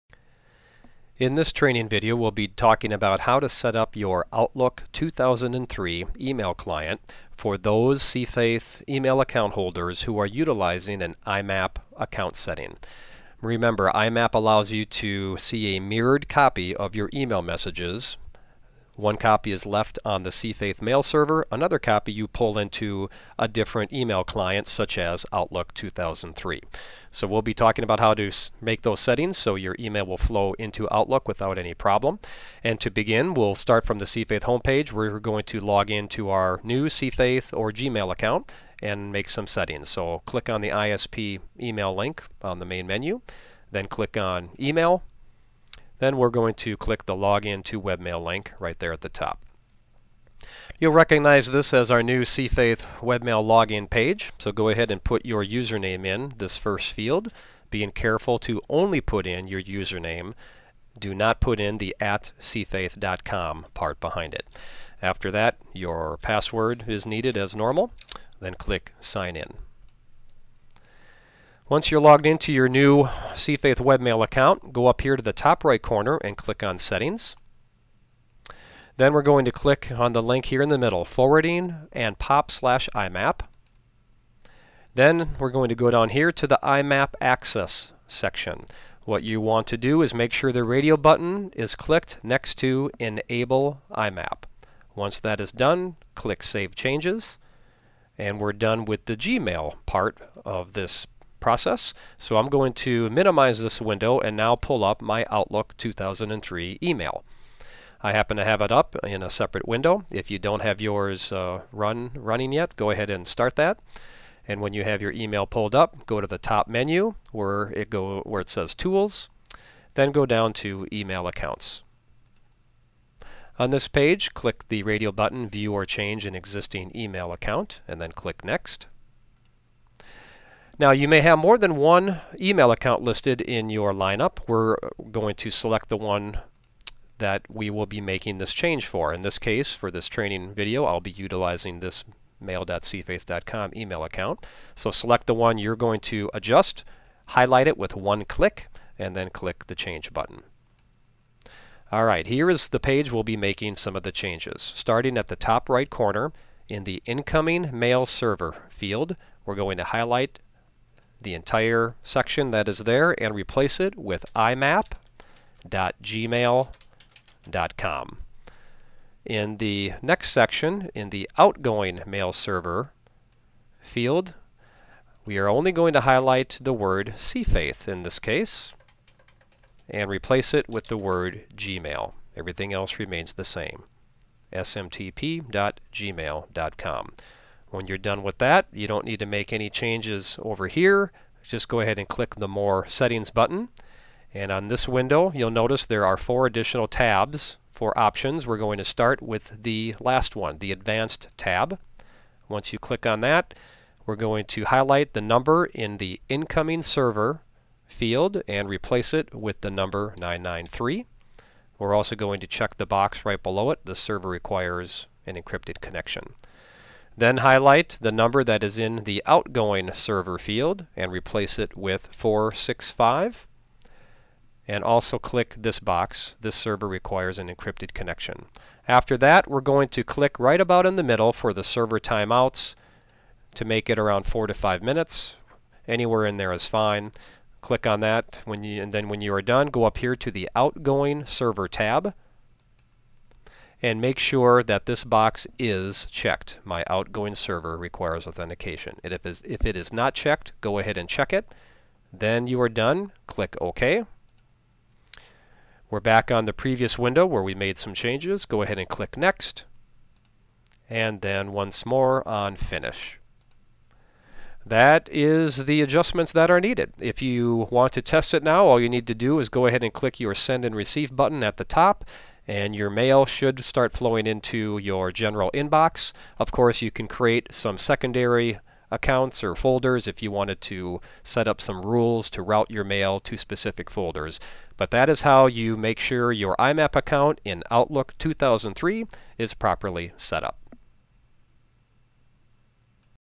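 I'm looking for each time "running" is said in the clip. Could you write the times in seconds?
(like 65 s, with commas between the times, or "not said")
112 s.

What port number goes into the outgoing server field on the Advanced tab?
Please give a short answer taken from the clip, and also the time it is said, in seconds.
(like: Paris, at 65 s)
465, at 222 s.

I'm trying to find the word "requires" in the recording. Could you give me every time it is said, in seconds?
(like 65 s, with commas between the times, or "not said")
214 s, 226 s, 247 s.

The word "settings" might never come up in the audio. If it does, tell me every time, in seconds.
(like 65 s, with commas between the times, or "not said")
12 s, 28 s, 39 s, 76 s, 192 s.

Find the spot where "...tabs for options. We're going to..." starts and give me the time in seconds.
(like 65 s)
196 s.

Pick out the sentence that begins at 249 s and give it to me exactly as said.
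And if, if it is not checked, go ahead and check it.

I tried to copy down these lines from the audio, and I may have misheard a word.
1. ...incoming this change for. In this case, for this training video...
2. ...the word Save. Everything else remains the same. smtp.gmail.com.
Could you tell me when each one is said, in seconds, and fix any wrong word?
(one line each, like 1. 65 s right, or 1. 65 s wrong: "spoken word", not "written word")
1. 138 s wrong: "making", not "incoming"
2. 180 s wrong: "Gmail", not "Save".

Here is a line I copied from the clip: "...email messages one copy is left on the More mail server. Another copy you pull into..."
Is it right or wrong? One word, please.
wrong.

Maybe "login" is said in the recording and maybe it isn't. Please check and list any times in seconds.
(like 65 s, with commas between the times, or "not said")
47 s, 53 s.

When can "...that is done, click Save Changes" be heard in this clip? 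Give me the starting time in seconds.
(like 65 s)
95 s.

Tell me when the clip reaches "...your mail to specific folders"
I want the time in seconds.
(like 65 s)
282 s.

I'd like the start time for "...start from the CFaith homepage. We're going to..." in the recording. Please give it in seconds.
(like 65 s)
33 s.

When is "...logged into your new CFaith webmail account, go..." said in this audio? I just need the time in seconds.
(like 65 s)
72 s.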